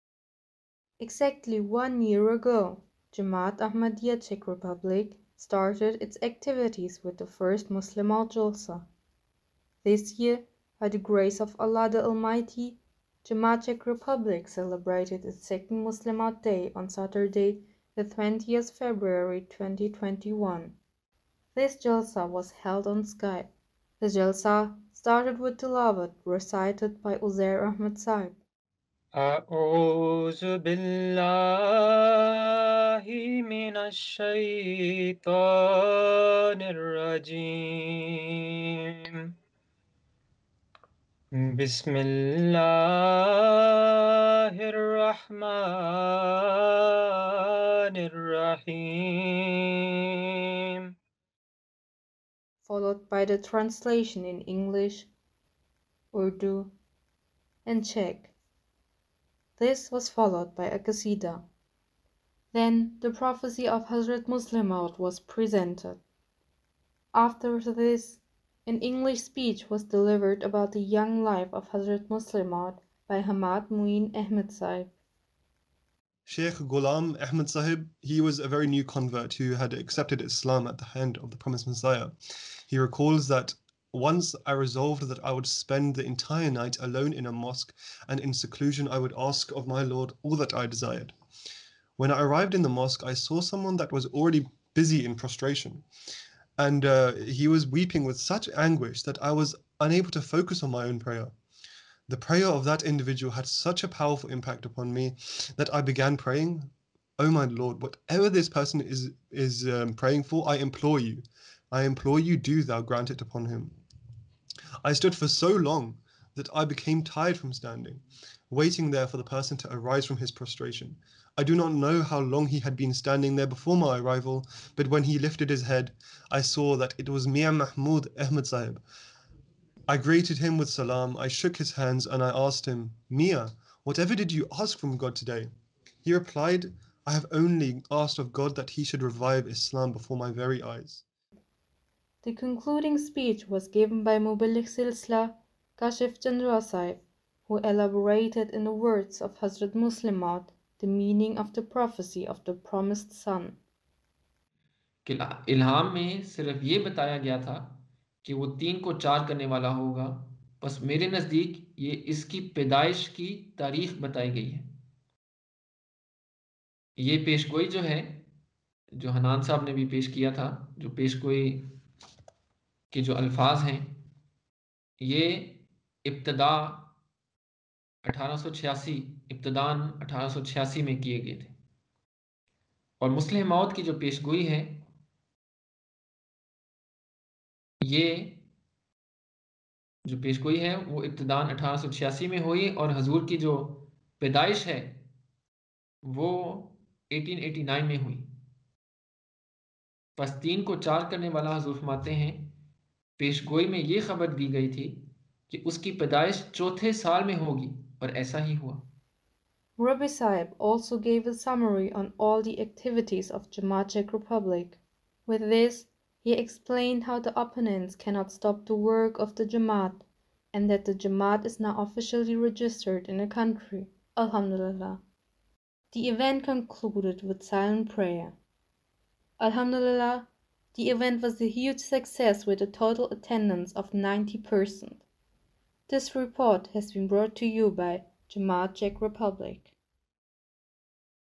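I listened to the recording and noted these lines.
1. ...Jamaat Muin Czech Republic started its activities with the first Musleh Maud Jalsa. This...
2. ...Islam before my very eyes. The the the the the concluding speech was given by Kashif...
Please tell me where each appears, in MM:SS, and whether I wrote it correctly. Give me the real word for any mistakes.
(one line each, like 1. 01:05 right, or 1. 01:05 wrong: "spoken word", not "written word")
1. 00:03 wrong: "Ahmadiyya", not "Muin"
2. 02:19 right.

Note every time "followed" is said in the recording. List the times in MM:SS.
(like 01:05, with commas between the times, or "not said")
00:52, 01:00.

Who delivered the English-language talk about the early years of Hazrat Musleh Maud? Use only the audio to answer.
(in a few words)
Hamad Muin Ahmed.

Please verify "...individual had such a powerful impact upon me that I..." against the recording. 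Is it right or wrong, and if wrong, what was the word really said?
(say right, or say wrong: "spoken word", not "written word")
right.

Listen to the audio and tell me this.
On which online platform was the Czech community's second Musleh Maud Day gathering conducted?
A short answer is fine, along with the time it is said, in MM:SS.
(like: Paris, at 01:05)
Skype, at 00:23.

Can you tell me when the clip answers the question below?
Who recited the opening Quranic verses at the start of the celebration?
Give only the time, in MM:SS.
00:27.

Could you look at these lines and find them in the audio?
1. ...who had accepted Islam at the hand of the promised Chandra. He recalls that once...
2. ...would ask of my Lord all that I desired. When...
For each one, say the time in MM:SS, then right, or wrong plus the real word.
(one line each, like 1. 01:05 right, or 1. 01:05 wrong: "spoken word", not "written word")
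1. 01:19 wrong: "Messiah", not "Chandra"
2. 01:28 right.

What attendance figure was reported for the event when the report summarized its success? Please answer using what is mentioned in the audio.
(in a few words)
90%.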